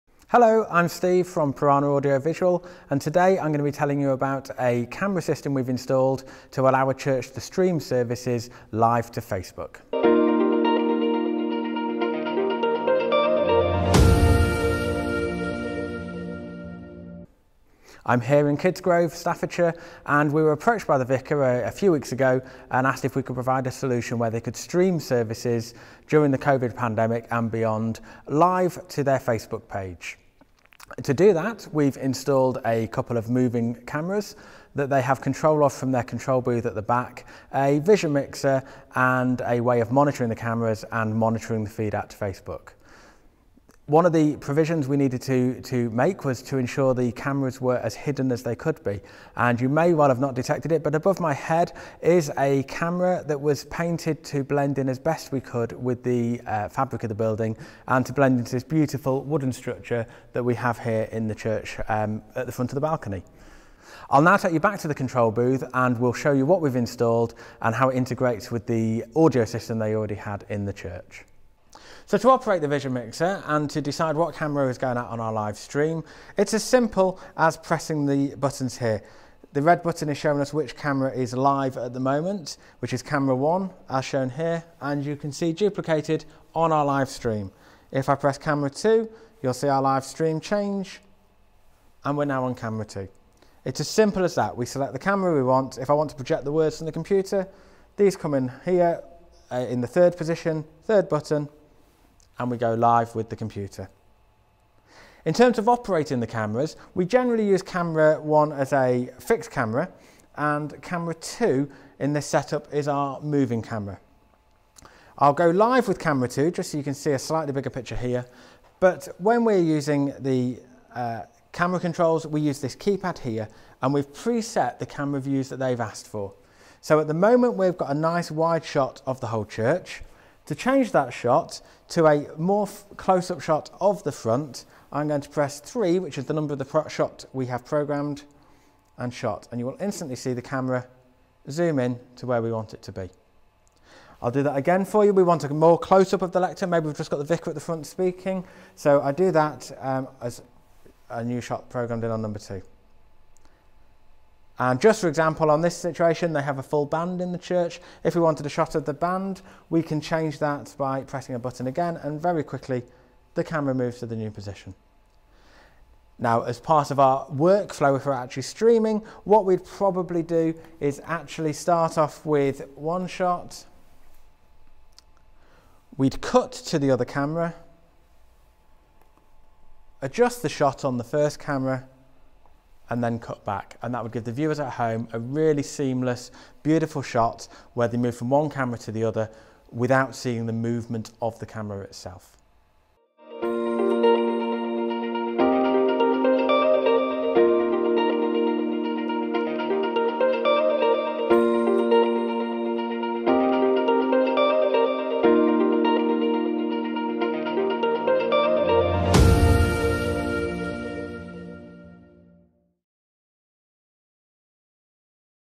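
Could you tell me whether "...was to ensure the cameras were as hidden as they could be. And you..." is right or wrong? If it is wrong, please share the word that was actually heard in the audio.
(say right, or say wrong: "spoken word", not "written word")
right.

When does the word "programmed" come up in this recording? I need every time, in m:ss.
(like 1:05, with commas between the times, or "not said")
2:17, 2:31.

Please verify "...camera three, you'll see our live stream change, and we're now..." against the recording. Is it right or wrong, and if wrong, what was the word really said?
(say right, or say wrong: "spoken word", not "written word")
wrong: "two", not "three".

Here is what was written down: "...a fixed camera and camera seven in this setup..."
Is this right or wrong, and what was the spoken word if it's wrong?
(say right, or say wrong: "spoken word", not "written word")
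wrong: "two", not "seven".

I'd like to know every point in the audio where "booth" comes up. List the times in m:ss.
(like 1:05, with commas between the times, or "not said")
0:36, 1:05.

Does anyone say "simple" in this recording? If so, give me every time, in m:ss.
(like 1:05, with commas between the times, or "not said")
1:16, 1:33.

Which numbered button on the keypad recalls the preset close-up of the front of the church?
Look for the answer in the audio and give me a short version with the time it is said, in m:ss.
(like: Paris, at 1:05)
3, at 2:15.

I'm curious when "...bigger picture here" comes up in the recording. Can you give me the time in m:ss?
1:57.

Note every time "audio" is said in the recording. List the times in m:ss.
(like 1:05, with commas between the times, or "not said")
0:01, 1:09.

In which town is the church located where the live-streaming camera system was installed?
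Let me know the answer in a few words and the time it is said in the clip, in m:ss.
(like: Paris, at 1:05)
Kidsgrove, at 0:18.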